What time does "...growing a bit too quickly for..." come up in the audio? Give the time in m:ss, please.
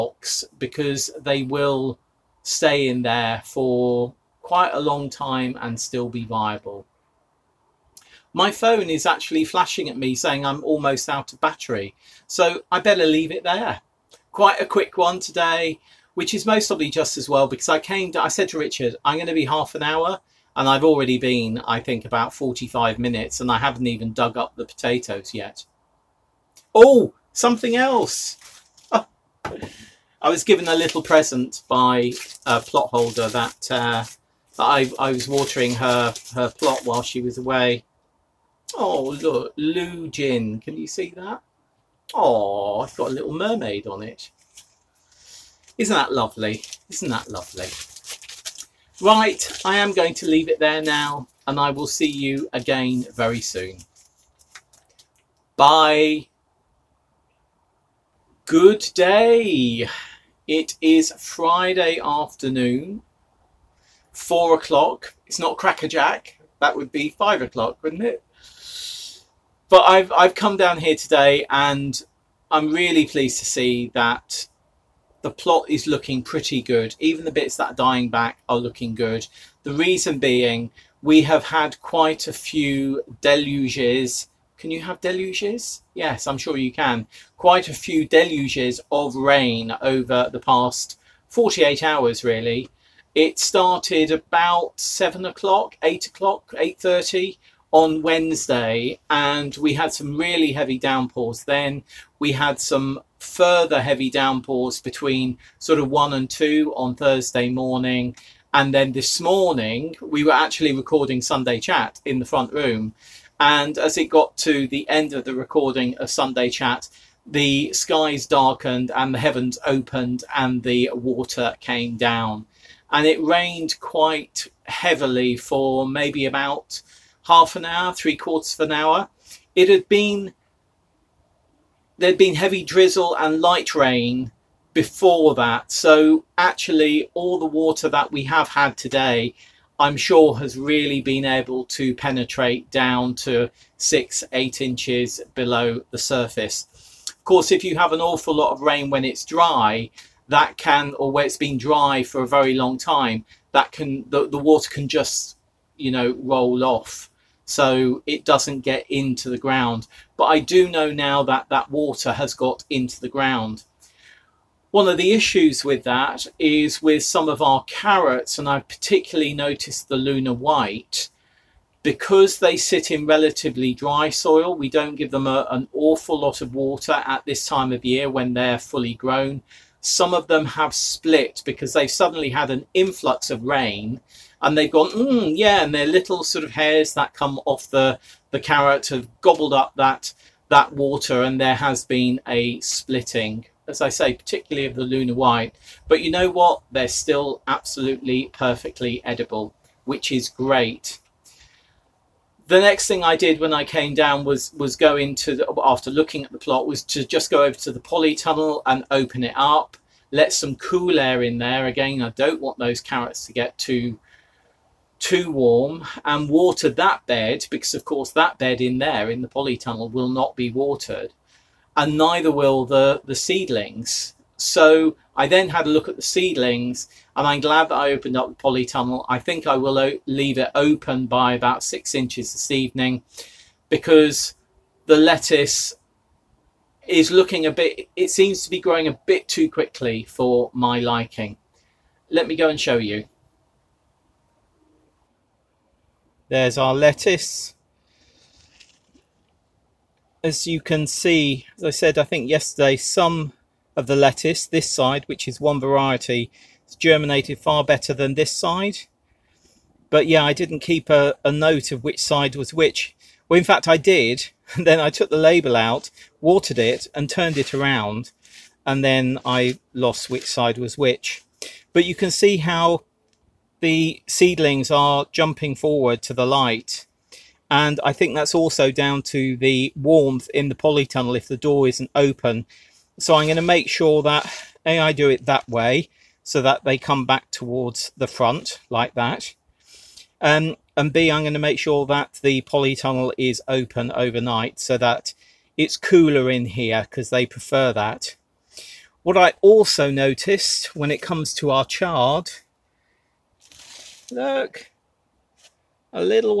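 3:58.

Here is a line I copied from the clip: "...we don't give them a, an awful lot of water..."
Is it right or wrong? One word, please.
right.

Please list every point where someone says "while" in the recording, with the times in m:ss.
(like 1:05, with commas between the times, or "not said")
0:36.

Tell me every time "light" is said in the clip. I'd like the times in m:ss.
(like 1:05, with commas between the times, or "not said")
2:13, 4:36.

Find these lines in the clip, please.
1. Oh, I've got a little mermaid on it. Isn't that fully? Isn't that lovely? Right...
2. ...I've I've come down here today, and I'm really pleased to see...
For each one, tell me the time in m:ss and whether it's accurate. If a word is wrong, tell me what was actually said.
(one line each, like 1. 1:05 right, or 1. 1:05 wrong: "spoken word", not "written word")
1. 0:42 wrong: "lovely", not "fully"
2. 1:09 right.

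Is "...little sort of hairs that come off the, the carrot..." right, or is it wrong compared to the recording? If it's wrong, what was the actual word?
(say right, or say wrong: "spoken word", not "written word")
right.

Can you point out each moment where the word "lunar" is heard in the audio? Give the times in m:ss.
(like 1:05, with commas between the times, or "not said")
2:49, 3:14.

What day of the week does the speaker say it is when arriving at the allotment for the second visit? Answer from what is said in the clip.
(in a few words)
Friday.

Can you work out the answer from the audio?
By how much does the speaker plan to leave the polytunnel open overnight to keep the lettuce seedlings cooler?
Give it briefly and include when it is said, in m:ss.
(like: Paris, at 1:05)
6 inches, at 3:51.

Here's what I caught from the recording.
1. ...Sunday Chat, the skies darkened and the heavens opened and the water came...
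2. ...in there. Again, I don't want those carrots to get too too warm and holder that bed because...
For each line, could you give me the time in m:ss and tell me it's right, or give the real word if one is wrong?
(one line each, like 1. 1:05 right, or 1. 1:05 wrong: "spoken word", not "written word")
1. 1:56 right
2. 3:31 wrong: "water", not "holder".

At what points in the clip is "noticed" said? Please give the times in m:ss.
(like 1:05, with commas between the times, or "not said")
2:49, 4:59.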